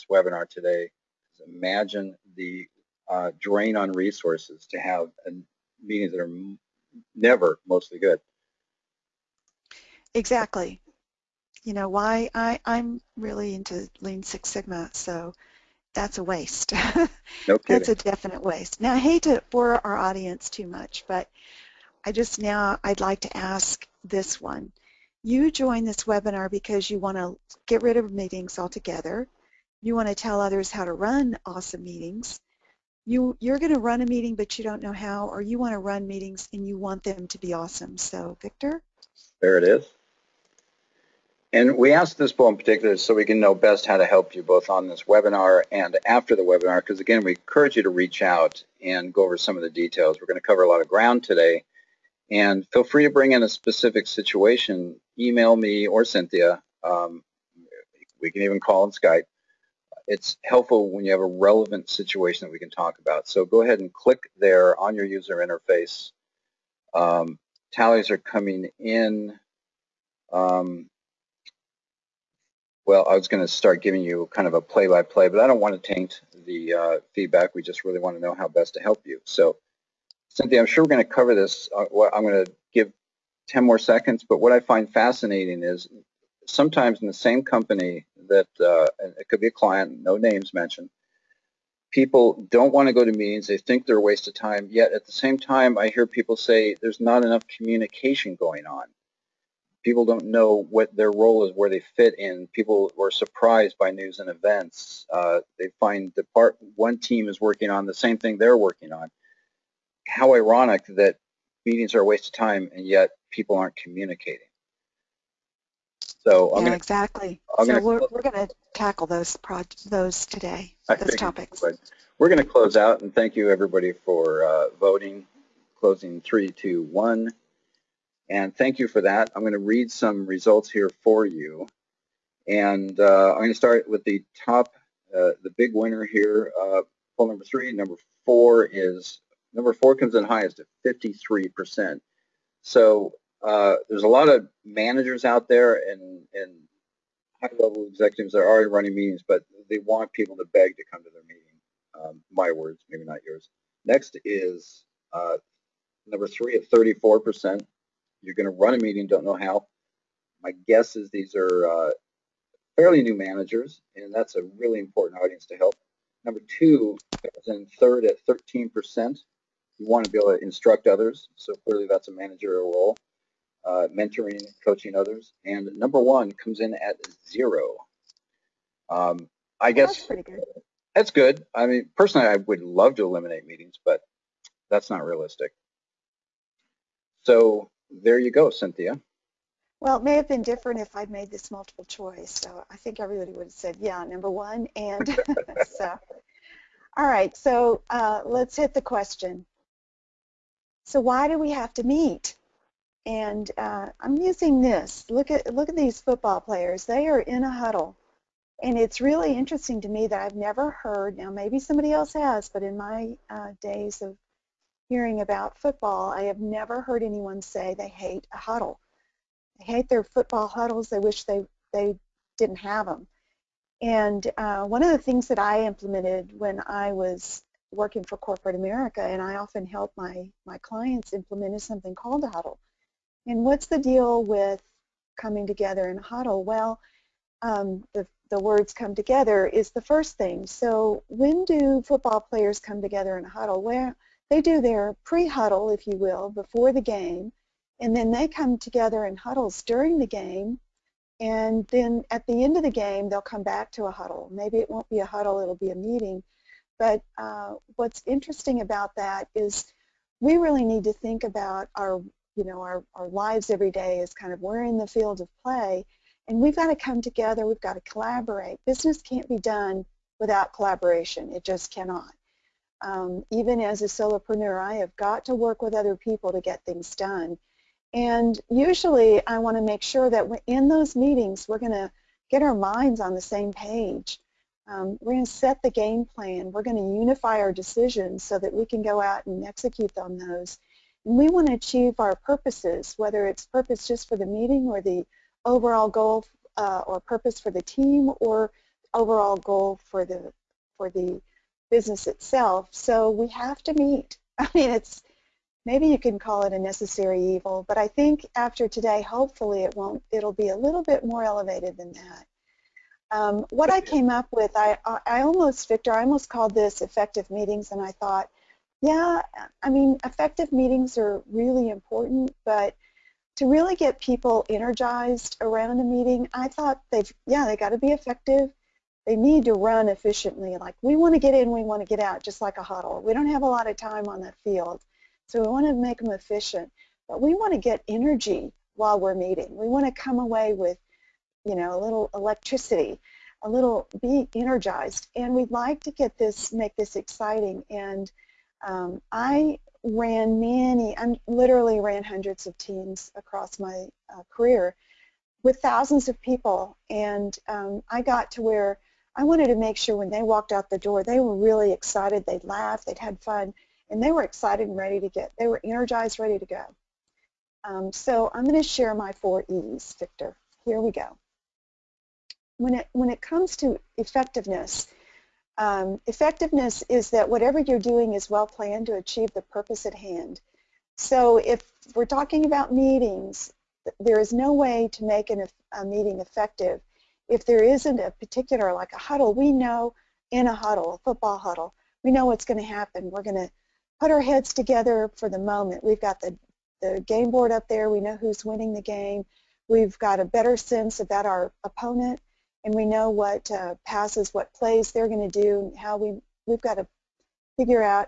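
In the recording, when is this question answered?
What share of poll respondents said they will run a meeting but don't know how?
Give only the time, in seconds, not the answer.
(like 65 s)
156 s.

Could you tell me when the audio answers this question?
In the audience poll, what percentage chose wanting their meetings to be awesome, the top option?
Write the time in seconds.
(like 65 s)
140 s.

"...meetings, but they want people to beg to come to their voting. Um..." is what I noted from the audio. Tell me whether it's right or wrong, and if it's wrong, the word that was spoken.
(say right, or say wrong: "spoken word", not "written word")
wrong: "meeting", not "voting".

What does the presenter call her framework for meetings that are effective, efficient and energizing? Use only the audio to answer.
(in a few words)
four E's.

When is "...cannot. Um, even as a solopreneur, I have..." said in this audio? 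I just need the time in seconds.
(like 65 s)
271 s.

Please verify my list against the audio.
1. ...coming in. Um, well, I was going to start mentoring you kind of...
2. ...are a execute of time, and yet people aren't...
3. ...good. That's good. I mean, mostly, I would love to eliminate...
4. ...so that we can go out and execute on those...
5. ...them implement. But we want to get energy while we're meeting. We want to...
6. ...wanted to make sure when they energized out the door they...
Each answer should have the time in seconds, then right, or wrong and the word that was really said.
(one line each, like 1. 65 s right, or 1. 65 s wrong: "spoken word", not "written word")
1. 68 s wrong: "giving", not "mentoring"
2. 111 s wrong: "waste", not "execute"
3. 180 s wrong: "personally", not "mostly"
4. 288 s right
5. 335 s wrong: "efficient", not "implement"
6. 359 s wrong: "walked", not "energized".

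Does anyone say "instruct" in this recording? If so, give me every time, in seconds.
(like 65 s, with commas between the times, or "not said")
170 s.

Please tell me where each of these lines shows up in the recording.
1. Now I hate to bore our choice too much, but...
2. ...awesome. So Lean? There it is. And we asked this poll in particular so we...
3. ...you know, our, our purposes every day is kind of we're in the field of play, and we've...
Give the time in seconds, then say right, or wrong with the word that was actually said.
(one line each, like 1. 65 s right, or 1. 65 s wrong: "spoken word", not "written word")
1. 18 s wrong: "audience", not "choice"
2. 37 s wrong: "Victor", not "Lean"
3. 262 s wrong: "lives", not "purposes".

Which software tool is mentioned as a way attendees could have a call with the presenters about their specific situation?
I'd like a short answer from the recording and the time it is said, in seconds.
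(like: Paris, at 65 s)
Skype, at 58 s.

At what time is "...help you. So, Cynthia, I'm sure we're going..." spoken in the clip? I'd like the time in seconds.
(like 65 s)
78 s.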